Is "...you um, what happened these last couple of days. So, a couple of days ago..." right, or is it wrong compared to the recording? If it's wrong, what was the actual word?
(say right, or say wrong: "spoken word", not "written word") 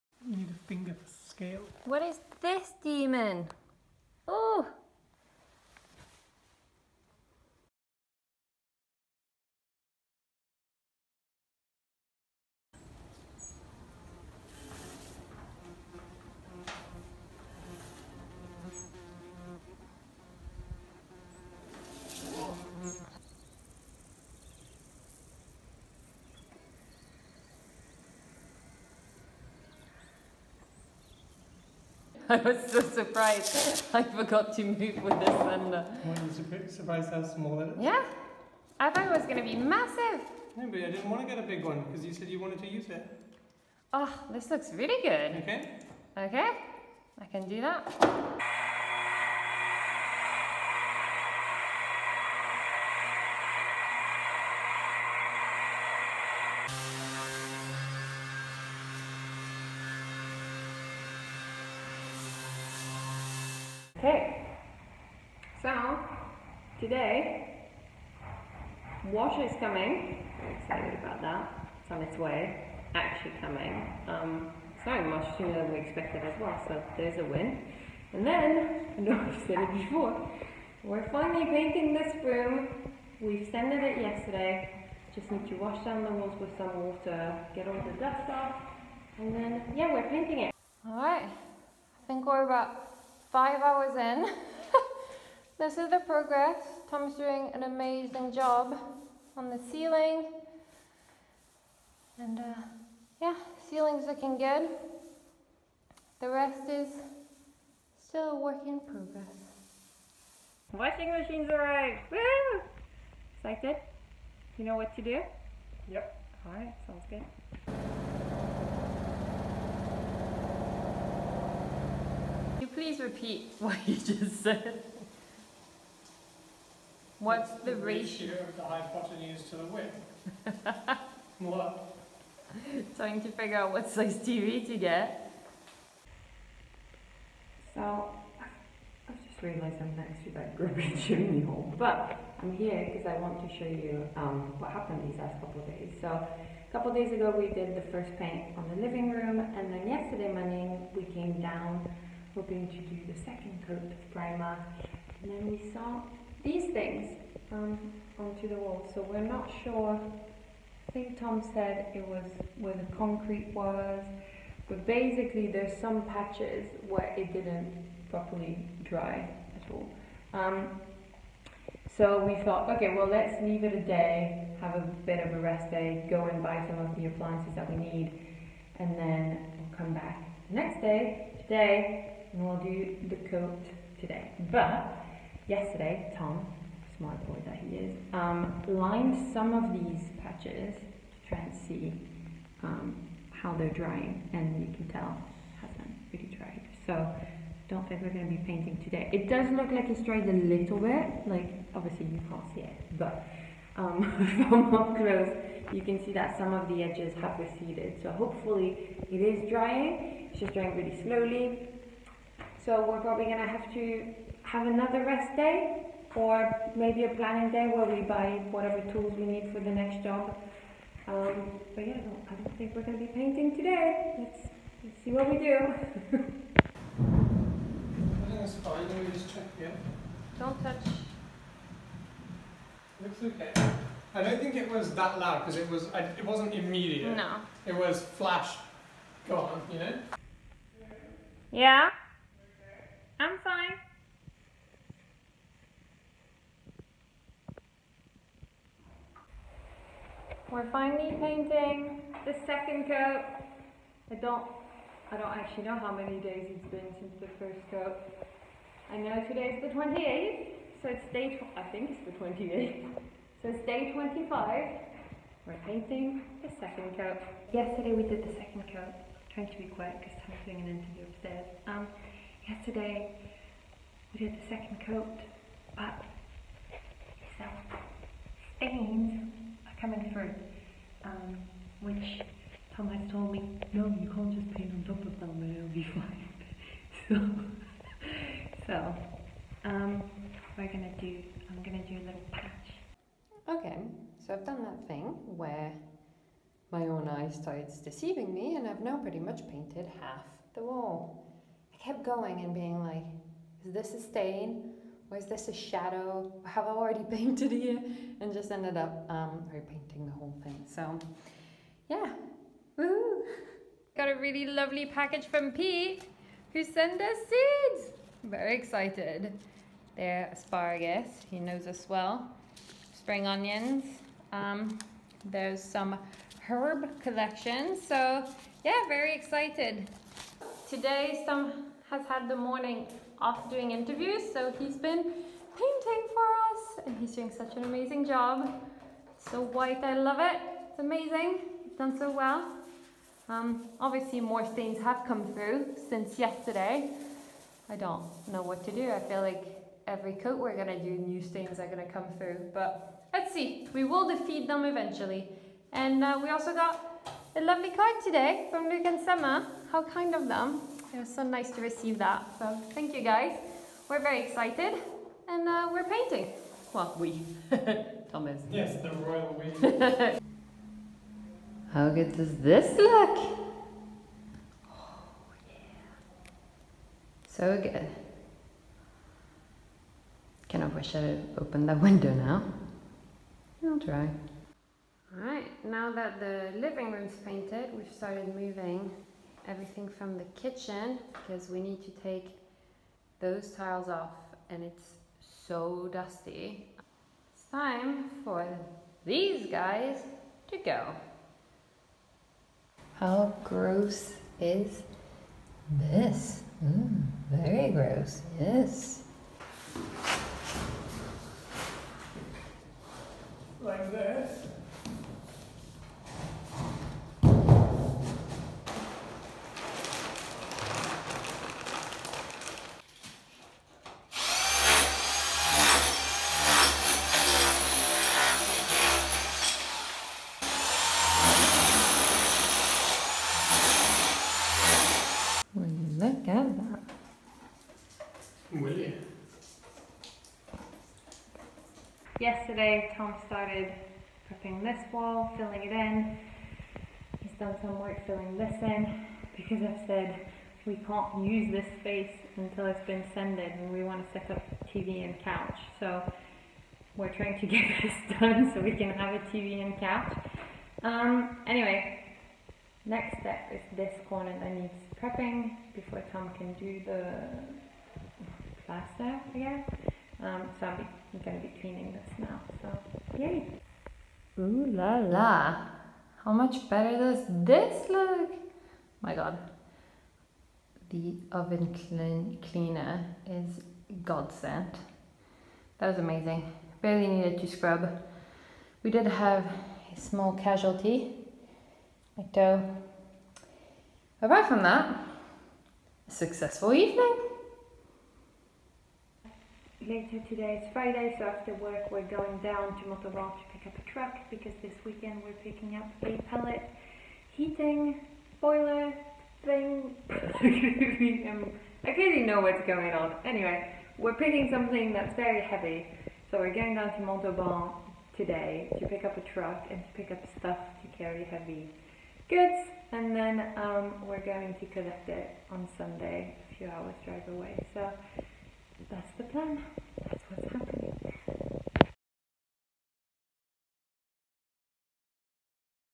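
right.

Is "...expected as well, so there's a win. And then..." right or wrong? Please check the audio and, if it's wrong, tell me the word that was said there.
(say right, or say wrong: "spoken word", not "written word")
right.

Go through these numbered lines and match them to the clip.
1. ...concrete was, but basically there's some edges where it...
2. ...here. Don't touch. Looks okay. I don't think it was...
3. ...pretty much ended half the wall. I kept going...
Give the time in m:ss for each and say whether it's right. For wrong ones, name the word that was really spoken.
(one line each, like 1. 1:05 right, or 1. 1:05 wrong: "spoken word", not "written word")
1. 2:42 wrong: "patches", not "edges"
2. 3:49 right
3. 4:58 wrong: "painted", not "ended".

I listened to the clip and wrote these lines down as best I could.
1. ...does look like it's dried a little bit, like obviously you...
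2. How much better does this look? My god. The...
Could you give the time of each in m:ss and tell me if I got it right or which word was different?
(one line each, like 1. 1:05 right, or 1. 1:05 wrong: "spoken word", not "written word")
1. 3:19 right
2. 7:56 right.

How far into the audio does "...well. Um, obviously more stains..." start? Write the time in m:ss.
5:42.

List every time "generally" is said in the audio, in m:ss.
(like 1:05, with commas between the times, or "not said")
not said.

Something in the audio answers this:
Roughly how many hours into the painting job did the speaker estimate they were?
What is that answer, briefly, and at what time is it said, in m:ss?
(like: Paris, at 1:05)
5 hours, at 1:33.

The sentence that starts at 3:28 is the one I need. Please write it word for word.
So hopefully it is drying, it's just drying really slowly.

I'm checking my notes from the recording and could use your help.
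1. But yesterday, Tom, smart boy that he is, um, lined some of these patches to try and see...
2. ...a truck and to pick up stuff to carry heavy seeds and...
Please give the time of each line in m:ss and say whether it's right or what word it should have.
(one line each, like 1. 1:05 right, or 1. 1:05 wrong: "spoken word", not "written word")
1. 3:04 right
2. 8:39 wrong: "goods", not "seeds".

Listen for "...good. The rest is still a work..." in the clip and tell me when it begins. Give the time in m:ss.
1:44.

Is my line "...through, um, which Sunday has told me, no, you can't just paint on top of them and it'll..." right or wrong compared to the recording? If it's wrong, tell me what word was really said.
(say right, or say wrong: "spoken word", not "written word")
wrong: "Tom", not "Sunday".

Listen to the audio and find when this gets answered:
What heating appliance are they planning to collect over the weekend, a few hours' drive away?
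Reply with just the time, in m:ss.
8:26.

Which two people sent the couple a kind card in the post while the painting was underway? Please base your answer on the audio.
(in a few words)
Luke and Summer.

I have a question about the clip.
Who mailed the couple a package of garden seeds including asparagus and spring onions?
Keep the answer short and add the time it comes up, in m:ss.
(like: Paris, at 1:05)
Pete, at 5:15.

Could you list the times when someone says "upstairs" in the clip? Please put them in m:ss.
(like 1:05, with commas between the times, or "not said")
4:31.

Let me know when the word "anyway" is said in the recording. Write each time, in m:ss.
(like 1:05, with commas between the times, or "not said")
7:41, 8:33.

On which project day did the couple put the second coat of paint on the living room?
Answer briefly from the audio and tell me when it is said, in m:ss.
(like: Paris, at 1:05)
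Day 25, at 4:23.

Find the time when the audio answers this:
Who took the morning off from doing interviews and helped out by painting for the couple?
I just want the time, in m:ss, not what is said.
5:31.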